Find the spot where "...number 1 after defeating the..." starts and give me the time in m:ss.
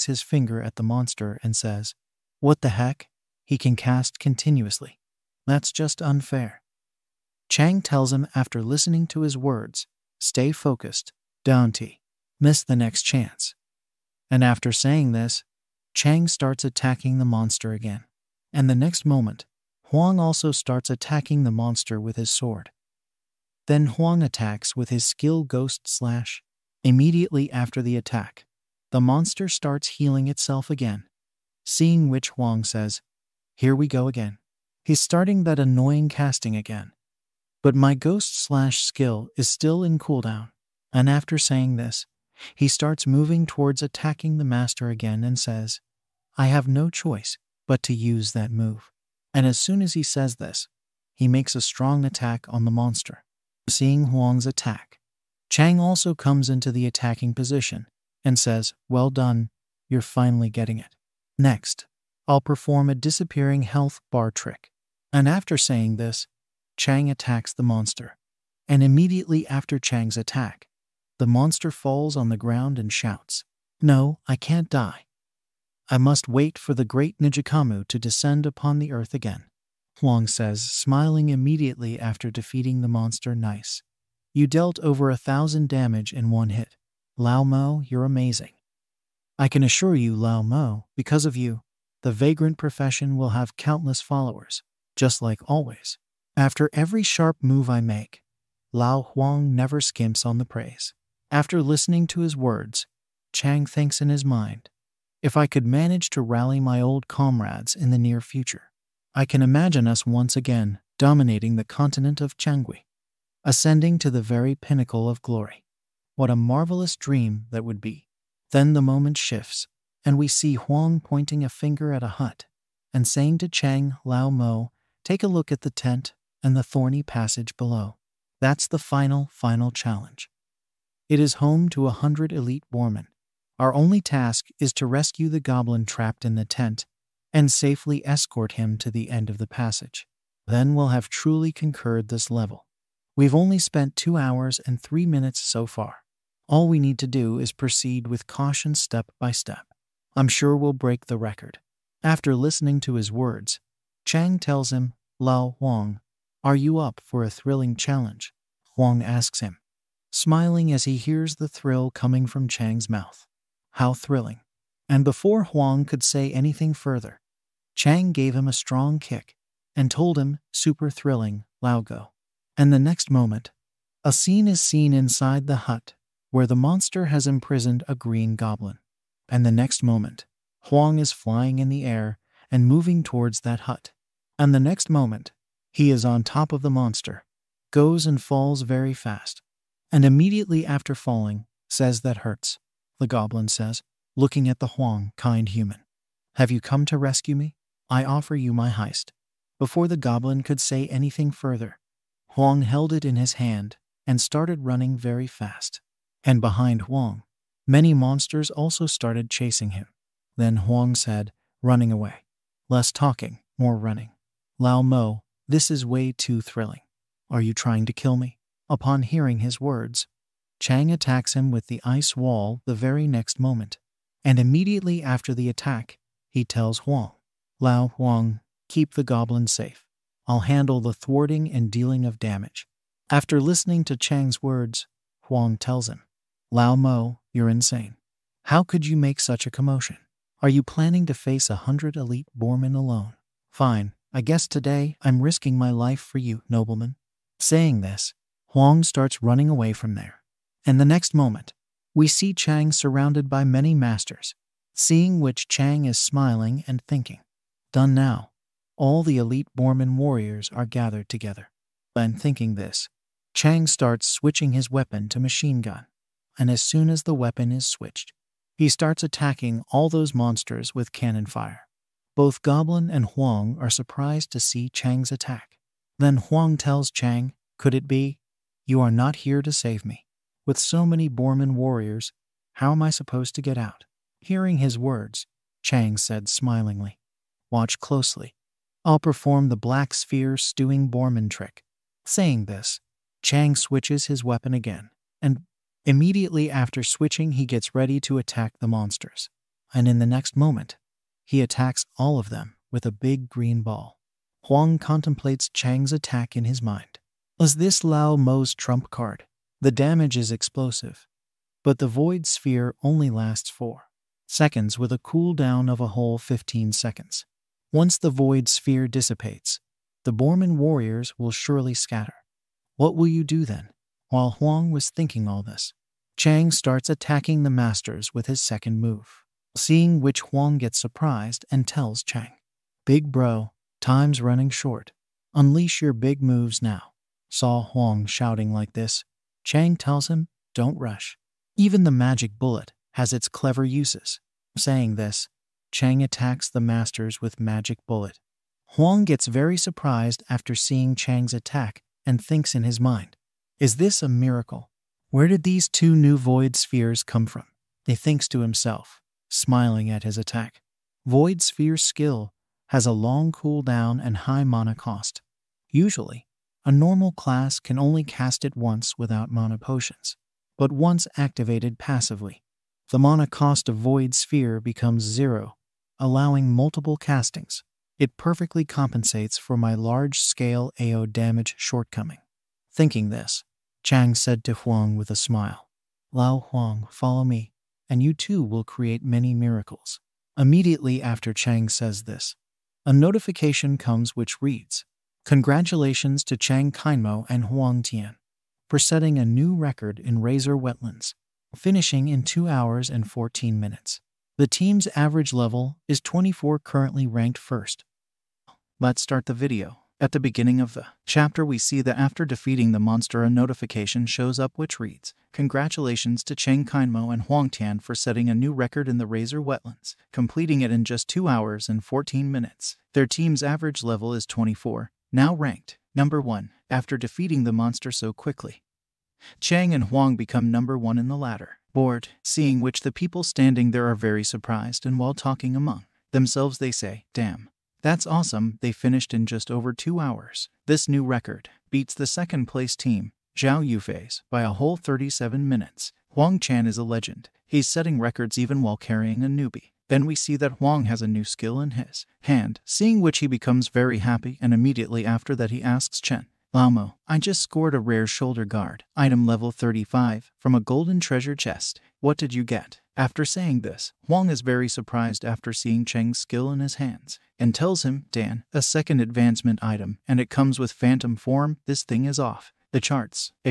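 7:05.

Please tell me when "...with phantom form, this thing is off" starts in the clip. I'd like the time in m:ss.
7:50.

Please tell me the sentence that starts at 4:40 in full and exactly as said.
With so many Borman warriors, how am I supposed to get out?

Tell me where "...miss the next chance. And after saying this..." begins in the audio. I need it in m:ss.
0:12.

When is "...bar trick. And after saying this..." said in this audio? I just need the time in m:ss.
1:04.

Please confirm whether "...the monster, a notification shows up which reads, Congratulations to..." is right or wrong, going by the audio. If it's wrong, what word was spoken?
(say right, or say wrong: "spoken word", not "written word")
right.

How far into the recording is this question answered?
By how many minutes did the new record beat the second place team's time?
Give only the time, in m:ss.
7:24.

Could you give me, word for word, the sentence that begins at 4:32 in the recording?
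Both Goblin and Huang are surprised to see Chang's attack.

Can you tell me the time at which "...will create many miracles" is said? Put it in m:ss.
6:28.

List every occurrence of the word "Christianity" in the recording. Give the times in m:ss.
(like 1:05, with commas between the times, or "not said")
not said.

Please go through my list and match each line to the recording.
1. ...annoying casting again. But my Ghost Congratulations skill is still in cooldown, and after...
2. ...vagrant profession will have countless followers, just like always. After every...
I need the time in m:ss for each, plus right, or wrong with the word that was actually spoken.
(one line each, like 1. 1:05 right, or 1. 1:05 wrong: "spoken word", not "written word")
1. 0:35 wrong: "Slash", not "Congratulations"
2. 1:32 right.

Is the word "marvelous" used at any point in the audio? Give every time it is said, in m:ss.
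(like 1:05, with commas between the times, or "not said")
1:56.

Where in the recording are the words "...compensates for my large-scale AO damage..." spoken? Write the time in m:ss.
6:18.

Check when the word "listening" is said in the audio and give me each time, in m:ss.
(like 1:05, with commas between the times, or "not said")
0:08, 1:41, 2:32, 3:53.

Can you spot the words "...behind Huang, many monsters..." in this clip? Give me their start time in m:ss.
3:26.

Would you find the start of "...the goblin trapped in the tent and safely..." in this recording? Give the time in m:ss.
2:15.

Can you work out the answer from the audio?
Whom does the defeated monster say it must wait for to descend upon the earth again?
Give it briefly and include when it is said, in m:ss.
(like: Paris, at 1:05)
Nijikamu, at 1:17.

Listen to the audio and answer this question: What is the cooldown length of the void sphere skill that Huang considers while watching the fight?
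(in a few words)
15 seconds.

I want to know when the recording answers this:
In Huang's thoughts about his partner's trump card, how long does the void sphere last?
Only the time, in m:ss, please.
5:13.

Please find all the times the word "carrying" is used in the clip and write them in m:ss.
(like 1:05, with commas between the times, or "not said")
7:28.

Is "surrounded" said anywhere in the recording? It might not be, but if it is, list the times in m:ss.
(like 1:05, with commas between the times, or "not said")
4:12.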